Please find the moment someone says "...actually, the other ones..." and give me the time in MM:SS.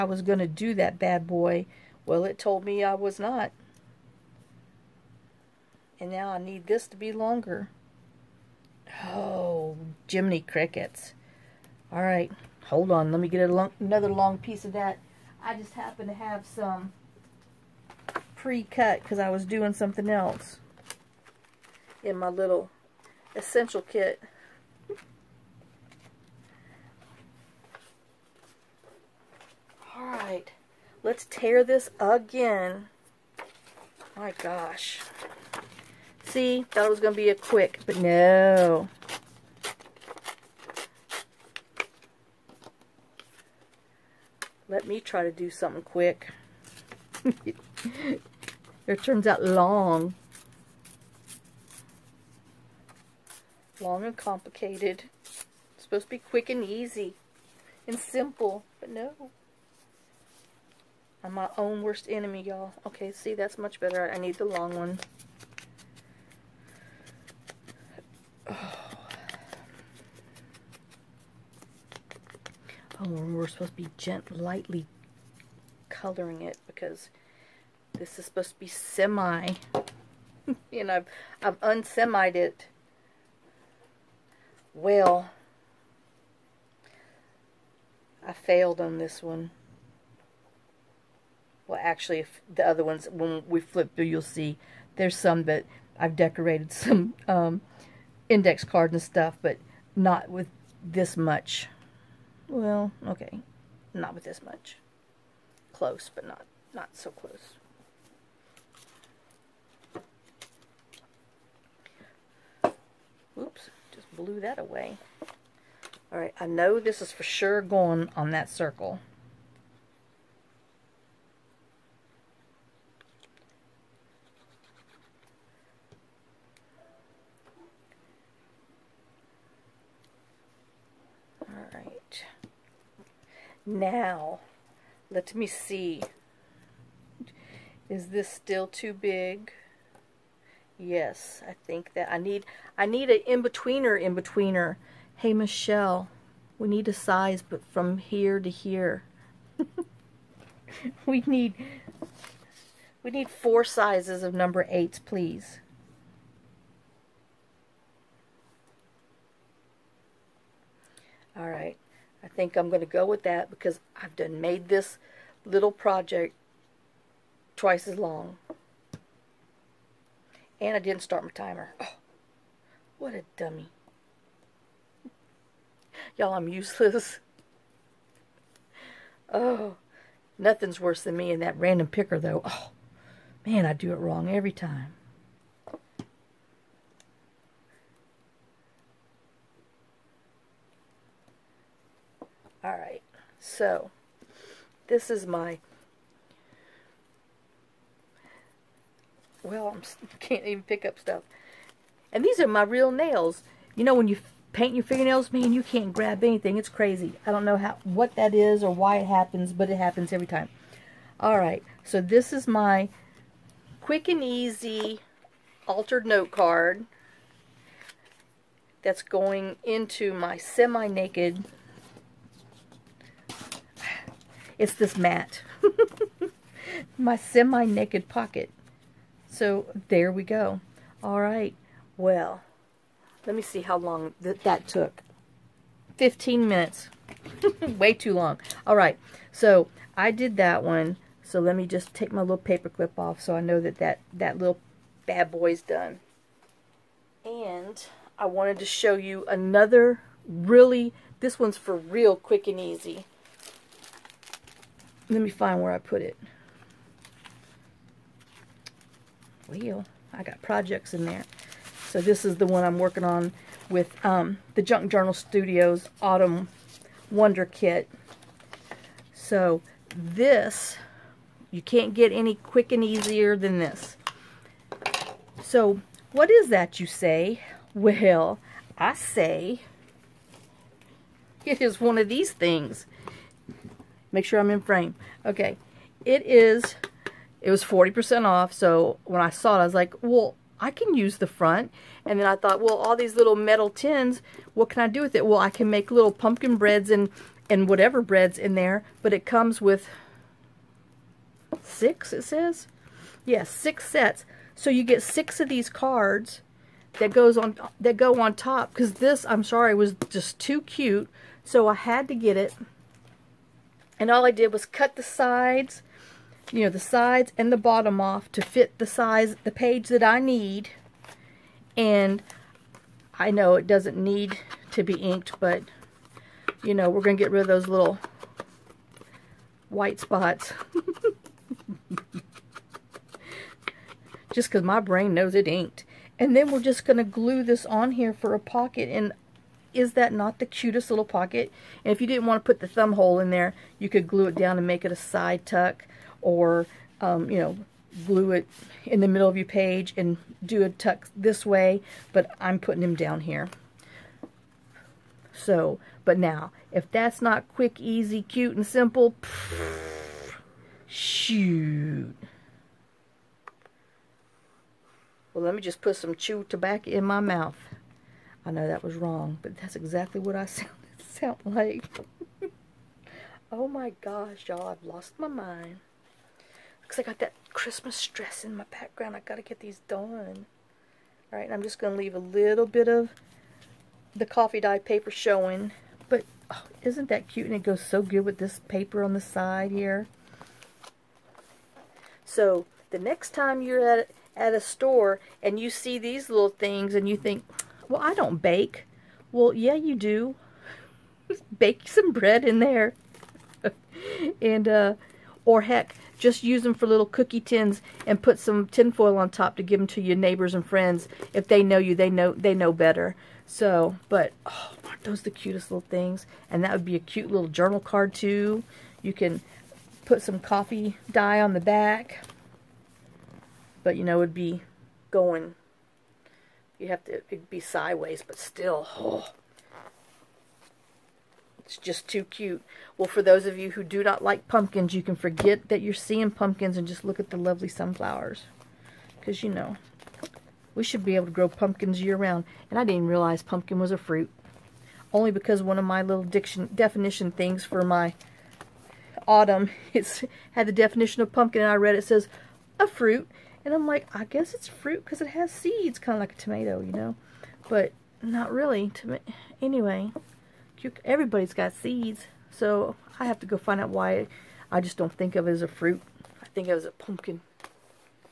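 01:31.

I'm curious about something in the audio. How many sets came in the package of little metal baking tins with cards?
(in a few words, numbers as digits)
6.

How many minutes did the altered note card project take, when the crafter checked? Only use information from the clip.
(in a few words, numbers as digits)
15 minutes.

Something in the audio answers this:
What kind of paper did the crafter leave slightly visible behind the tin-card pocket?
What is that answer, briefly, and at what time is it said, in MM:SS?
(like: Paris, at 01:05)
coffee dye paper, at 06:24.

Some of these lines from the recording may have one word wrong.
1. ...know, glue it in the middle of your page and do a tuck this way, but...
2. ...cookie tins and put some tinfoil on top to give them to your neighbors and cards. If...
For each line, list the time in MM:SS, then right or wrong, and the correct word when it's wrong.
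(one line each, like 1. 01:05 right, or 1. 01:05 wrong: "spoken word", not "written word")
1. 05:47 right
2. 06:47 wrong: "friends", not "cards".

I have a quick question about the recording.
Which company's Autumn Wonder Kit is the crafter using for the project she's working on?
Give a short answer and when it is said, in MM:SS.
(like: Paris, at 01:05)
Junk Journal Studios, at 04:24.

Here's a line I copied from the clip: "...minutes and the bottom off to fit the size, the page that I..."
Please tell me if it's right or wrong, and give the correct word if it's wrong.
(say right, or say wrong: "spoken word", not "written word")
wrong: "sides", not "minutes".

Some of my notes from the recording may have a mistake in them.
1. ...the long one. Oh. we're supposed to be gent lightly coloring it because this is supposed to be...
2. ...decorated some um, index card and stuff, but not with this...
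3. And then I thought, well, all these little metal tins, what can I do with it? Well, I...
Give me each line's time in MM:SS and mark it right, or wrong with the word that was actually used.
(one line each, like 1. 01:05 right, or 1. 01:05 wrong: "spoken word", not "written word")
1. 01:04 right
2. 01:36 right
3. 04:52 right.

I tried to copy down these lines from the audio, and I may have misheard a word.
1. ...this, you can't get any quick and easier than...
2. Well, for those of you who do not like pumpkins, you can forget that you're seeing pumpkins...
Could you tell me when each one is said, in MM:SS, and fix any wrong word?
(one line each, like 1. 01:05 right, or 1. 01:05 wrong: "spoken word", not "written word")
1. 04:29 right
2. 07:12 right.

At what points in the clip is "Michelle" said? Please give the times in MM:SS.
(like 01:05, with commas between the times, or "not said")
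02:25.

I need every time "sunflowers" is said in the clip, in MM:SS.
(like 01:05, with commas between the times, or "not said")
07:17.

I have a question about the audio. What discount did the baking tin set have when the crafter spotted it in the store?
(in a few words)
40% off.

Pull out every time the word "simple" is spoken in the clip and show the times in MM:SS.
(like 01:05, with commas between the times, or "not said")
00:57, 05:58.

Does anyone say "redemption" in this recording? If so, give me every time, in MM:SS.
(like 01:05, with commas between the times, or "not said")
not said.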